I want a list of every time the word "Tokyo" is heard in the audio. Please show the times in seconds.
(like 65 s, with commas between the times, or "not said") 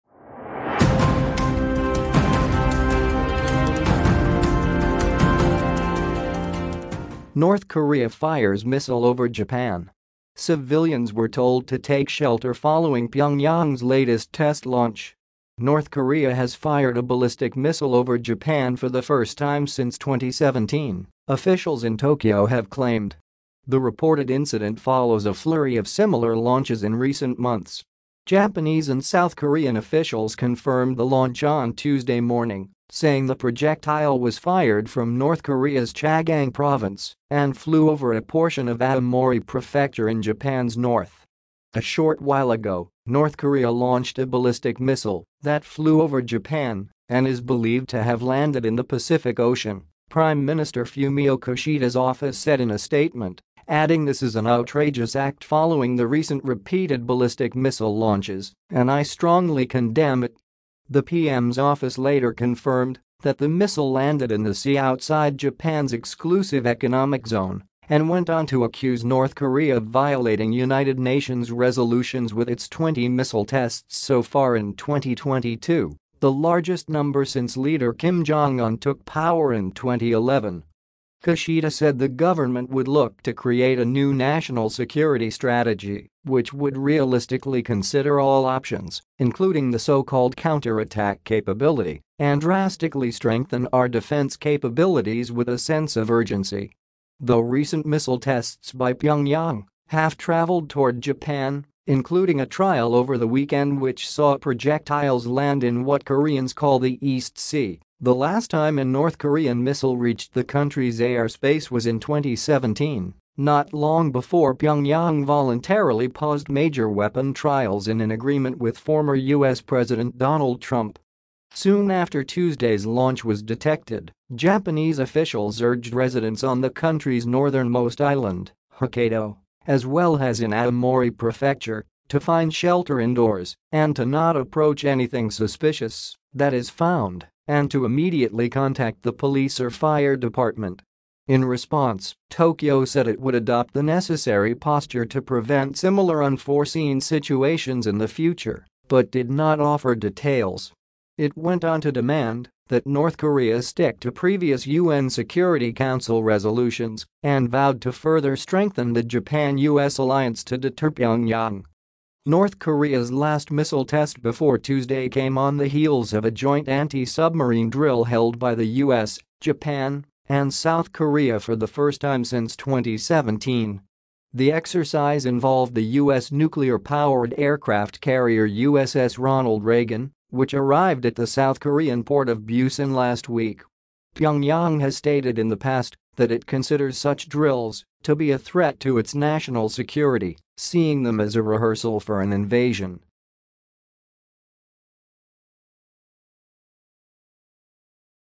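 21 s, 142 s.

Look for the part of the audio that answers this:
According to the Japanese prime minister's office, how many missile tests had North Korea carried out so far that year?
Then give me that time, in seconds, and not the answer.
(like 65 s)
72 s.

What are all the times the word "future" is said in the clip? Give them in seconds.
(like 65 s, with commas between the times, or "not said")
148 s.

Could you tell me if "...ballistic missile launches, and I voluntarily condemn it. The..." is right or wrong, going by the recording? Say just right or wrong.
wrong.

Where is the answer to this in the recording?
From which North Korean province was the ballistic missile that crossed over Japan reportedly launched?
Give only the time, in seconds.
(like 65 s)
35 s.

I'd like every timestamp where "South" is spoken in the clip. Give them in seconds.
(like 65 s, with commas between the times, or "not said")
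29 s, 170 s, 181 s.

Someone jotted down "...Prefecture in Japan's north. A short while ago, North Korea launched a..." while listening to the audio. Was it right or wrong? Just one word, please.
right.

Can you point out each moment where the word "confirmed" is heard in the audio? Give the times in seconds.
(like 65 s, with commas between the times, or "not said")
30 s, 62 s.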